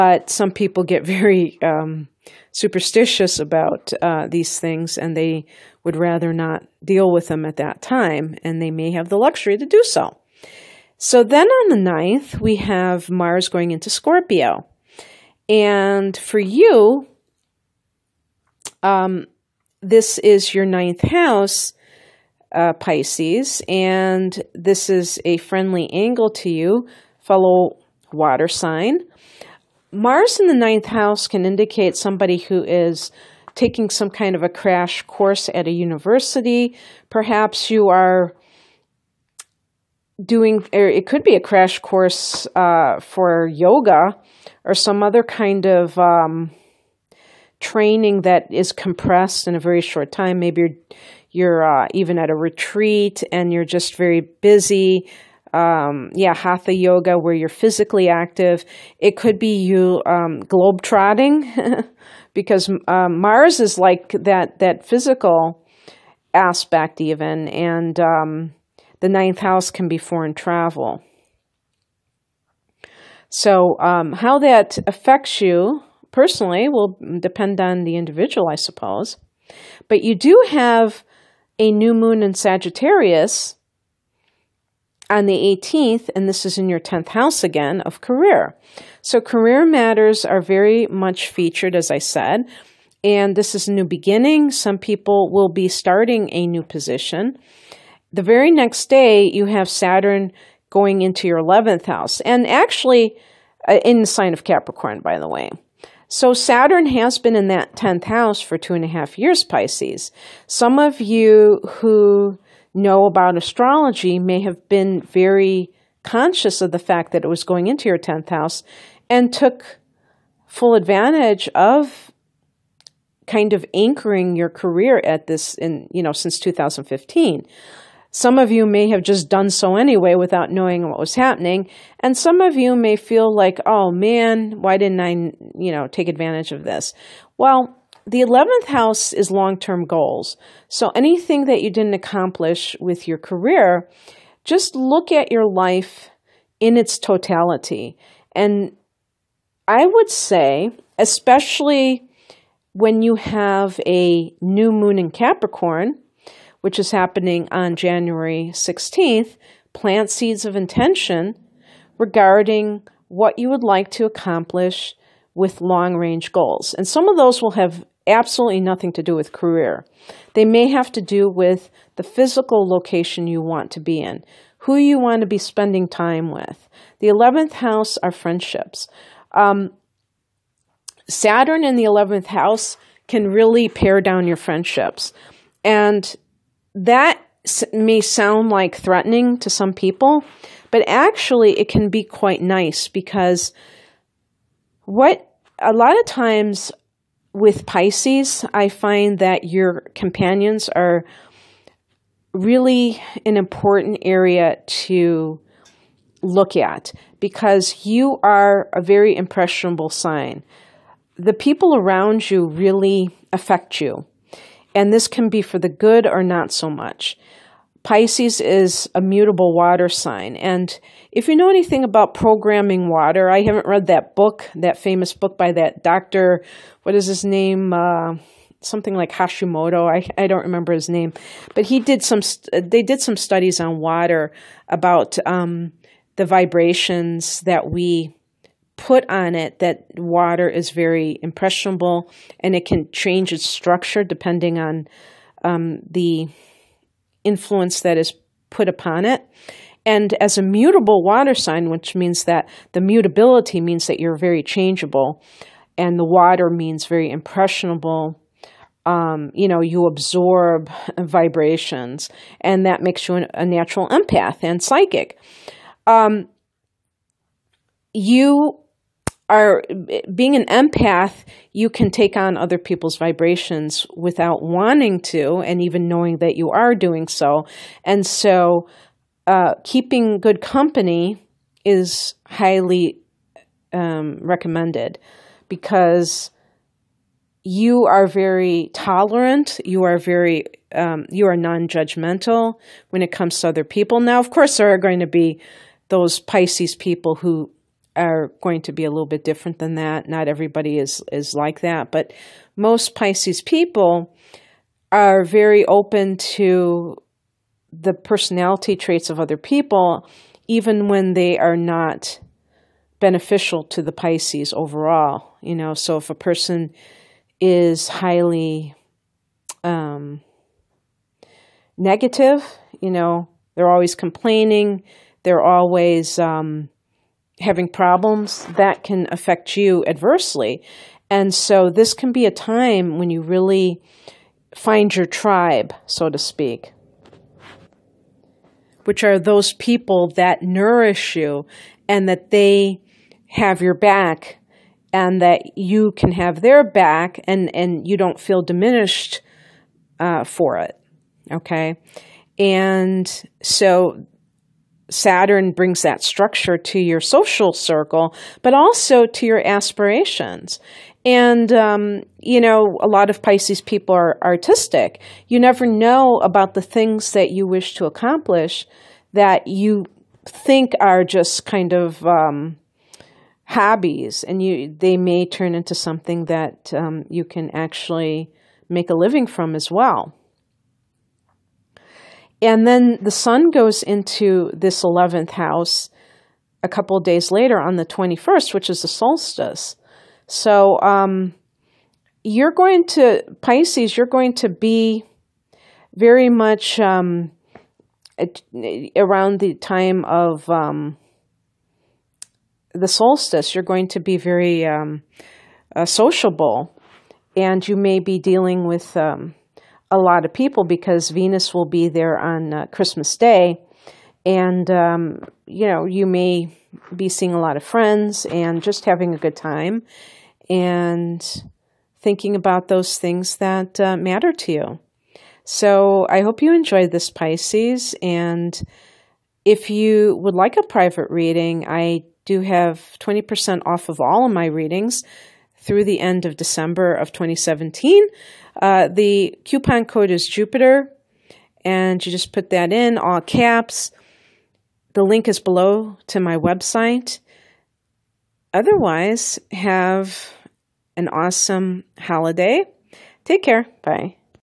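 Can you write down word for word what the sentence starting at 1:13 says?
So, um, how that affects you personally will depend on the individual, I suppose.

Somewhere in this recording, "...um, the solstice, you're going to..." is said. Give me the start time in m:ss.
6:40.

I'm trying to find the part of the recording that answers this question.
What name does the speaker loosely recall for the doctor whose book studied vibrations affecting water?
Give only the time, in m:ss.
3:49.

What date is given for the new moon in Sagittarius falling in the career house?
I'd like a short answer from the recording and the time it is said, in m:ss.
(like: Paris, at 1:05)
18th, at 1:25.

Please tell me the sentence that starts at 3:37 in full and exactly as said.
Pisces is a mutable water sign.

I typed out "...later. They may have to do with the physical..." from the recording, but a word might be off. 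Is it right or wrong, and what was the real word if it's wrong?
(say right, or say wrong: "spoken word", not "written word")
wrong: "career", not "later".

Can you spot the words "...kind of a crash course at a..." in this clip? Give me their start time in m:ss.
0:34.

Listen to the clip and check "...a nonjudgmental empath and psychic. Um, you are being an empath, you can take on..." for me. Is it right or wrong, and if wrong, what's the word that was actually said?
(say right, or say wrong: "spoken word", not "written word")
wrong: "natural", not "nonjudgmental".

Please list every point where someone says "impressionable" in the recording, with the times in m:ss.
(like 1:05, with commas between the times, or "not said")
3:29, 4:01, 4:17.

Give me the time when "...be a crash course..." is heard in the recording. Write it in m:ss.
0:41.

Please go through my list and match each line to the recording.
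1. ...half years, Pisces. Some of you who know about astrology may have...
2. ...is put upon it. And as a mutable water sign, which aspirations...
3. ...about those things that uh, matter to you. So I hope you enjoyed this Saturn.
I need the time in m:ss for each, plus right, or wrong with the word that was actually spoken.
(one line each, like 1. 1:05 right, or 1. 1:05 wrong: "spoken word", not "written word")
1. 1:48 right
2. 4:07 wrong: "means", not "aspirations"
3. 7:02 wrong: "Pisces", not "Saturn".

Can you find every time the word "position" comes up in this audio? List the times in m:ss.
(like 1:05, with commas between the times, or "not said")
1:36.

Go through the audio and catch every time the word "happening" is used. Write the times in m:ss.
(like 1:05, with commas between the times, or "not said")
2:11, 2:36.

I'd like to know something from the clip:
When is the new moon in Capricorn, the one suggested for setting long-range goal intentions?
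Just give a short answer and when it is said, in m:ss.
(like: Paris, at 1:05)
January 16th, at 2:37.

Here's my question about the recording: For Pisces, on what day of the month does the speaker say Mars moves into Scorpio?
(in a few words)
9th.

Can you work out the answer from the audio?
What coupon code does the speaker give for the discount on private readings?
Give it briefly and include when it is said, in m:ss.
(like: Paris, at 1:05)
Jupiter, at 7:20.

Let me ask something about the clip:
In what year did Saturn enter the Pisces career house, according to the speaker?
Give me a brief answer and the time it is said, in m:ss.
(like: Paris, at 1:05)
2015, at 2:06.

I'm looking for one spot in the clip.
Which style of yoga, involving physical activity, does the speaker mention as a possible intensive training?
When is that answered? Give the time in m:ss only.
0:56.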